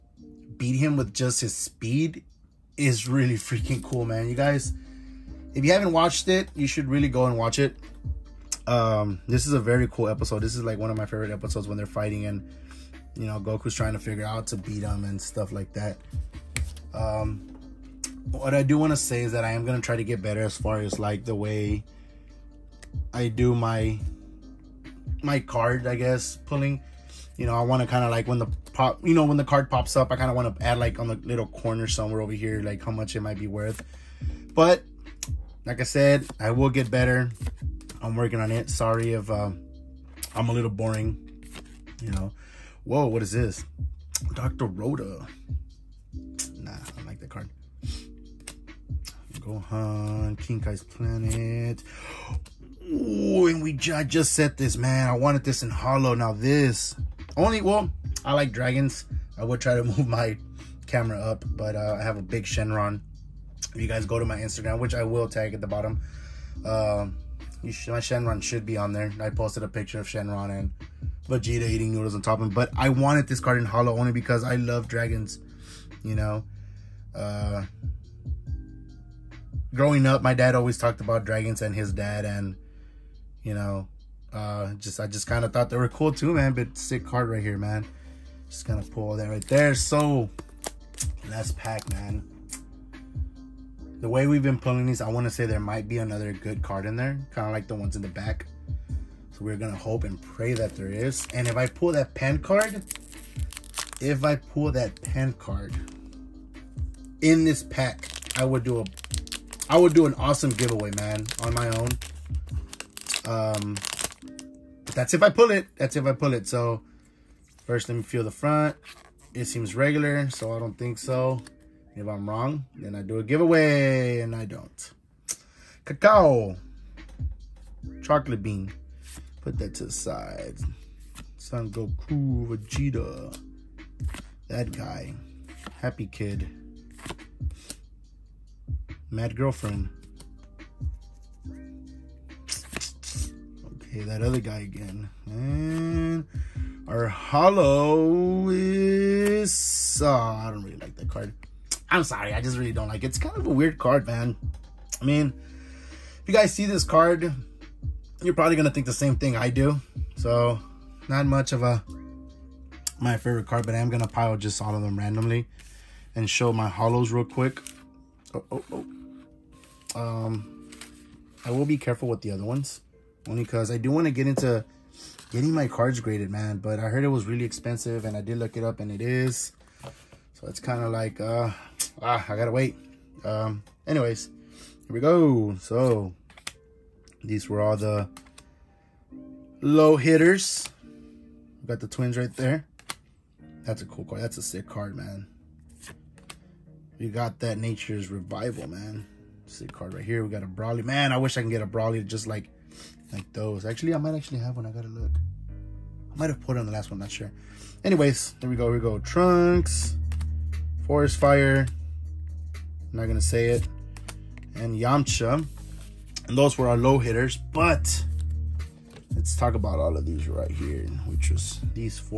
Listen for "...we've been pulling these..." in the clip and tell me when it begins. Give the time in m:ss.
1:34.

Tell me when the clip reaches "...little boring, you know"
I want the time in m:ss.
0:40.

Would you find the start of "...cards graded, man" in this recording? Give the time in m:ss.
2:55.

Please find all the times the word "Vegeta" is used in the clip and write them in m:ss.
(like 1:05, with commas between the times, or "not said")
1:11, 2:12.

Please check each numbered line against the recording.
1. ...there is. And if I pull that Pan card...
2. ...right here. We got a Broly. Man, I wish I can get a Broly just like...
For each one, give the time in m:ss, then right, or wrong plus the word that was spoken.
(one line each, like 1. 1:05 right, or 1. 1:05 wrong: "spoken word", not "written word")
1. 1:40 right
2. 3:19 right.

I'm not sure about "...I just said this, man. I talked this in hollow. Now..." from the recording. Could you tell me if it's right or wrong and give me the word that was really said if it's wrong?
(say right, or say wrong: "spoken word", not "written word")
wrong: "wanted", not "talked".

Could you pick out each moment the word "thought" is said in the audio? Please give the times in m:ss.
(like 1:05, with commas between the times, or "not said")
1:25.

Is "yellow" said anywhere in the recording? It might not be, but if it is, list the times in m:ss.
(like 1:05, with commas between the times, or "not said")
not said.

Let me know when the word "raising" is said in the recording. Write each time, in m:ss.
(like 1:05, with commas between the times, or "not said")
not said.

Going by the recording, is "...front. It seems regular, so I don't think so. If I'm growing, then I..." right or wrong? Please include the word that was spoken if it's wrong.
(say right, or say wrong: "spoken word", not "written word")
wrong: "wrong", not "growing".